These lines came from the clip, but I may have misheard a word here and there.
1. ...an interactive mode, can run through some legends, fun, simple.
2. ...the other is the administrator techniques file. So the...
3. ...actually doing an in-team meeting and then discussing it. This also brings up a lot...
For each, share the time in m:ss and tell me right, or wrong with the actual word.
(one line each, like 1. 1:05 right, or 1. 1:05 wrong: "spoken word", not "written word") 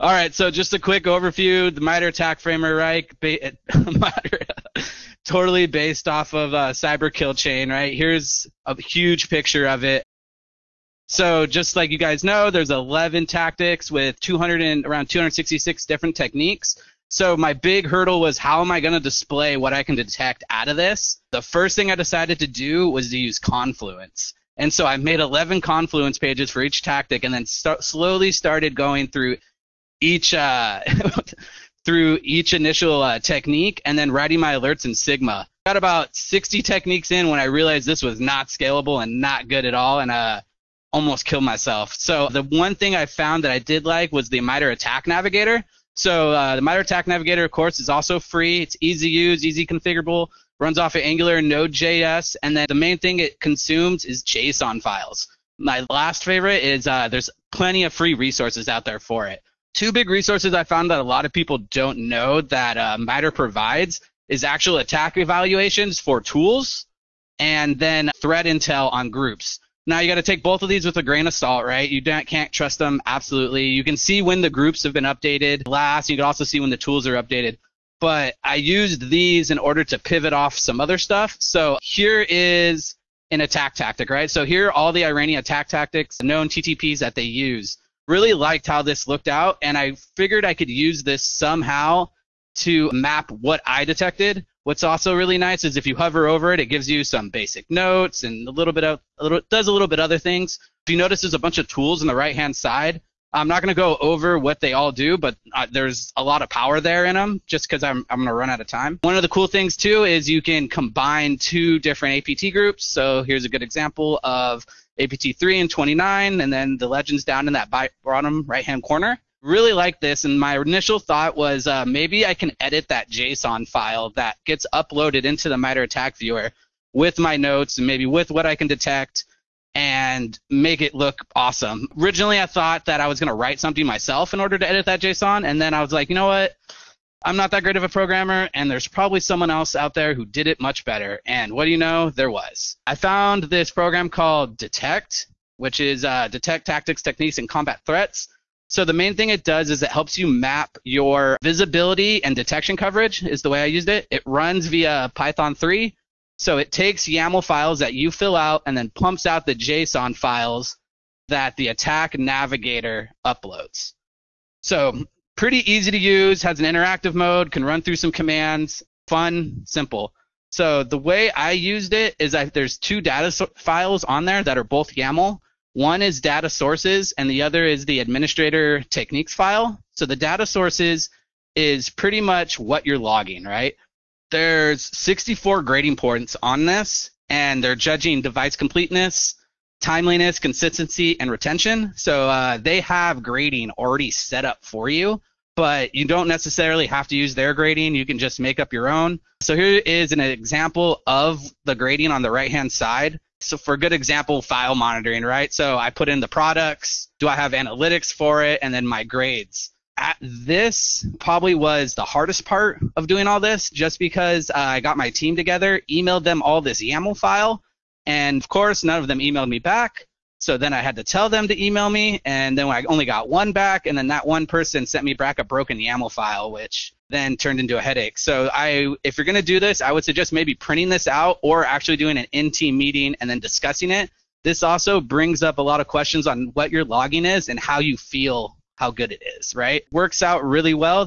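1. 2:46 wrong: "commands", not "legends"
2. 2:57 right
3. 3:51 right.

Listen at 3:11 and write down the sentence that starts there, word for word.
So uh, they have grading already set up for you, but you don't necessarily have to use their grading.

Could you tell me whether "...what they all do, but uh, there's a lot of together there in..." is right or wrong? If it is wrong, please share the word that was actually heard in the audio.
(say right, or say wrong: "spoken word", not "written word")
wrong: "power", not "together".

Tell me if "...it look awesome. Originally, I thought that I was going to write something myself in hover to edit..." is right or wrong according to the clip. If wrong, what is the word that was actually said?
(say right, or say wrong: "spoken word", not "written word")
wrong: "order", not "hover".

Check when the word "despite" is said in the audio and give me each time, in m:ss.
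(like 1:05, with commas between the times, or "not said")
not said.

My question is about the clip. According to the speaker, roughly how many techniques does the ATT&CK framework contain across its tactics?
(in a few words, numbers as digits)
266.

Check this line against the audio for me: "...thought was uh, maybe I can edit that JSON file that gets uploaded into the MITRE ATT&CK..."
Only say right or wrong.
right.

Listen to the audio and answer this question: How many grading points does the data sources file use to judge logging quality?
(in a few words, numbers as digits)
64.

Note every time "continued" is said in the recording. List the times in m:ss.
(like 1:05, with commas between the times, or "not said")
not said.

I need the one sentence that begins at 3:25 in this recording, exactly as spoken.
So I put in the products, do I have analytics for it, and then my grades.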